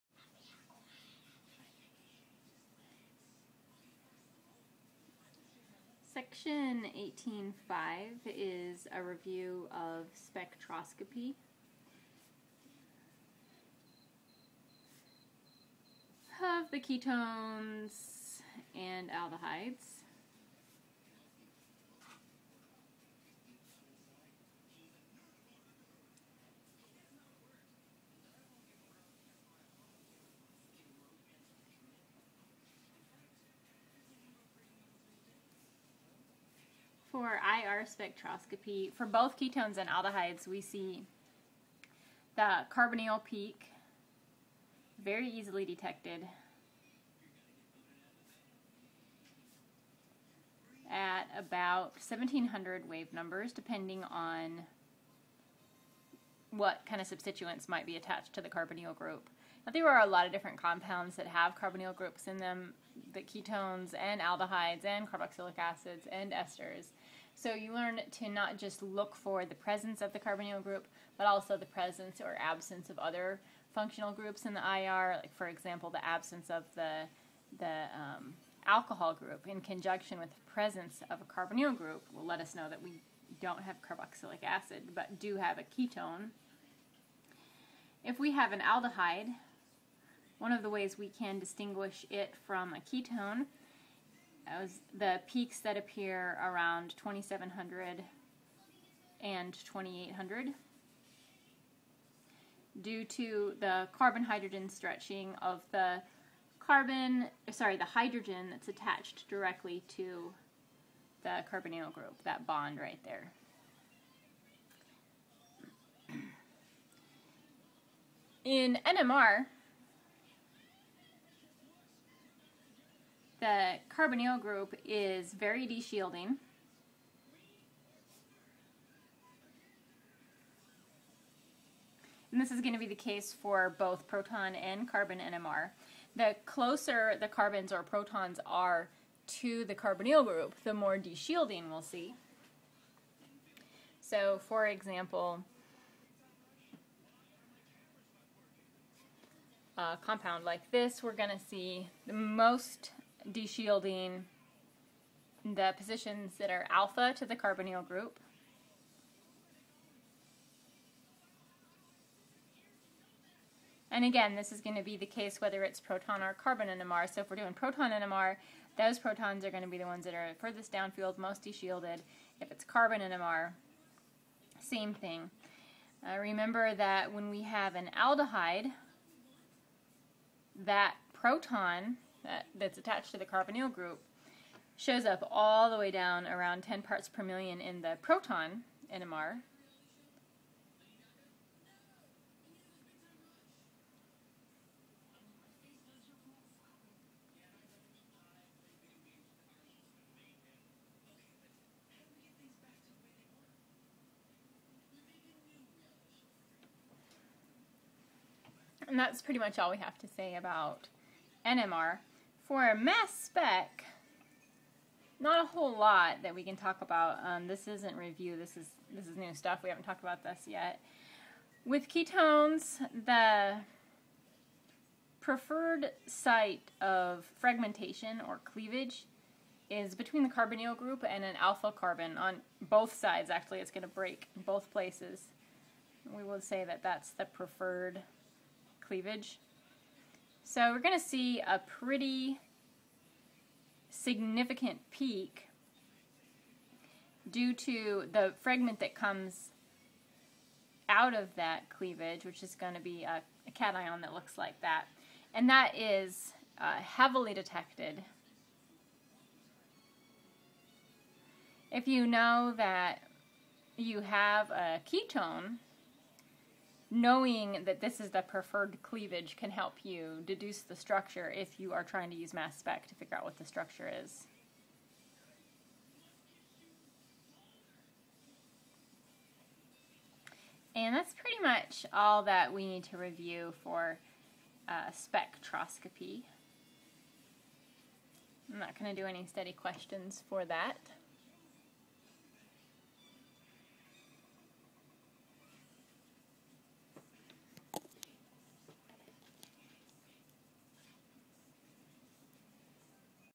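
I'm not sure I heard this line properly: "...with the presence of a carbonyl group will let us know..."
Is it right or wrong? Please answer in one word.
right.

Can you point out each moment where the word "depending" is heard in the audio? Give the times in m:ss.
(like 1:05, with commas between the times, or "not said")
0:53.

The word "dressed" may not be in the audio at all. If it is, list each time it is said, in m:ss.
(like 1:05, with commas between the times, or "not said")
not said.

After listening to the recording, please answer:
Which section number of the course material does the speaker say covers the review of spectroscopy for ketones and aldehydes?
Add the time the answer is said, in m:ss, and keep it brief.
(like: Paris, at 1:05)
18.5, at 0:06.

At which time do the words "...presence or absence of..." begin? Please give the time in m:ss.
1:11.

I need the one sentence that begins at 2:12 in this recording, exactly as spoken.
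And this is going to be the case for both proton and carbon NMR.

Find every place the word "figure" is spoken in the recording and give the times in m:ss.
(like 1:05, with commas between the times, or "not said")
4:32.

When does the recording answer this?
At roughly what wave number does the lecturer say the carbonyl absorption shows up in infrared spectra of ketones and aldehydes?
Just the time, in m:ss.
0:51.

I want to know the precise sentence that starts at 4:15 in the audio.
And that is uh, heavily detected.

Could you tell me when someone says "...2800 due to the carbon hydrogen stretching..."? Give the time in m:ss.
1:39.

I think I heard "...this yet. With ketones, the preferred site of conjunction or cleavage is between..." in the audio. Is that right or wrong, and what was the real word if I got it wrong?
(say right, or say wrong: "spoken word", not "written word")
wrong: "fragmentation", not "conjunction".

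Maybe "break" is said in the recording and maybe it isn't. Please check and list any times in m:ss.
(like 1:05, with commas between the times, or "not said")
3:53.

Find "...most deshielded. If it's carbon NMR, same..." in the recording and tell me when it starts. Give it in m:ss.
2:51.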